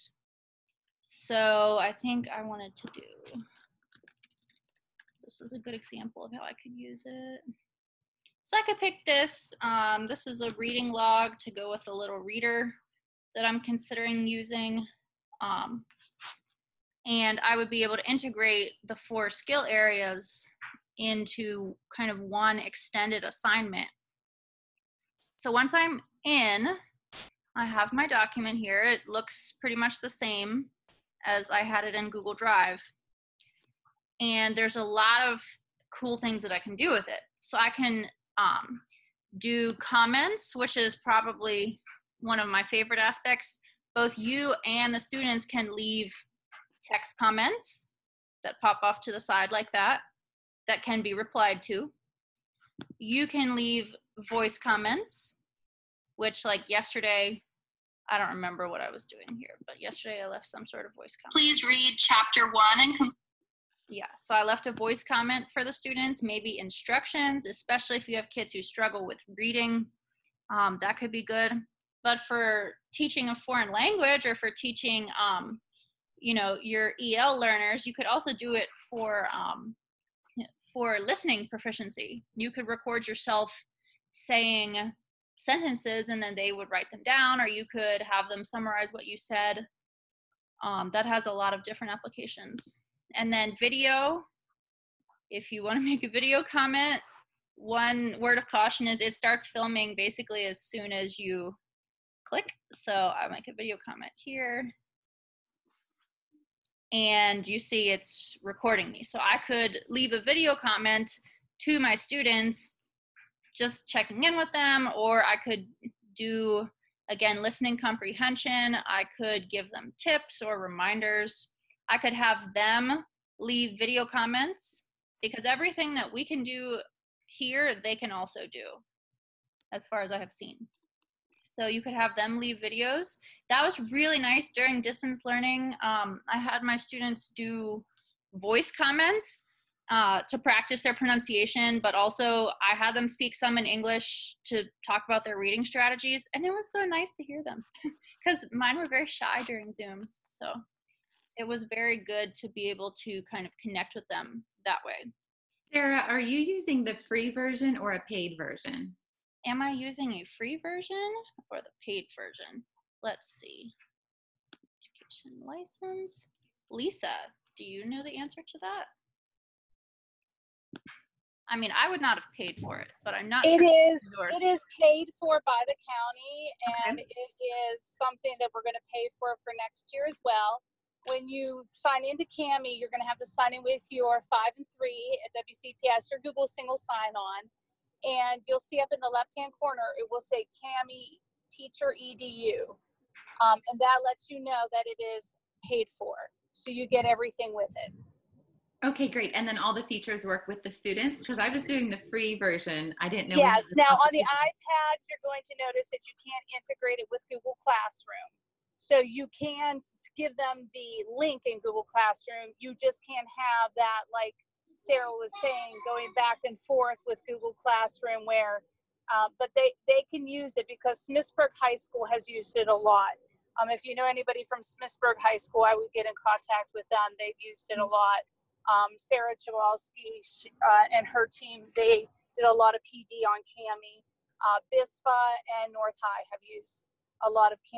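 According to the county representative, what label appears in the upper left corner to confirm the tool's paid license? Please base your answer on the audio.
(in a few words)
Kami teacher edu.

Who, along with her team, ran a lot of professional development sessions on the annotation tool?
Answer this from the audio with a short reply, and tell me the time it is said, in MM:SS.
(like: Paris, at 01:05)
Sarah Chowalski, at 03:48.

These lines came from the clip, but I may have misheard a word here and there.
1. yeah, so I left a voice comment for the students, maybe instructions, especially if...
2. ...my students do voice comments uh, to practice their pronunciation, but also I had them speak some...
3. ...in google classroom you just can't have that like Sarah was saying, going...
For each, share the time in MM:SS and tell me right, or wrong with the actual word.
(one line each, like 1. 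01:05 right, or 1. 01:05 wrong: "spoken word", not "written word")
1. 01:03 right
2. 02:16 right
3. 03:31 right.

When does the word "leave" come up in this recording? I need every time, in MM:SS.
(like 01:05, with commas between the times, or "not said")
00:45, 00:53, 01:49, 02:03, 02:12.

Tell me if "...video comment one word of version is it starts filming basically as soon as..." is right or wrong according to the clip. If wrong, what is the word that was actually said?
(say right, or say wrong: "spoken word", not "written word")
wrong: "caution", not "version".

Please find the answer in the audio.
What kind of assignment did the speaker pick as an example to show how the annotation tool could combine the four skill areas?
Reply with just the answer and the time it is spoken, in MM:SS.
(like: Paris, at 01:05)
reading log, at 00:10.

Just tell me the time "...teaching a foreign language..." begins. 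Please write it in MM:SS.
01:12.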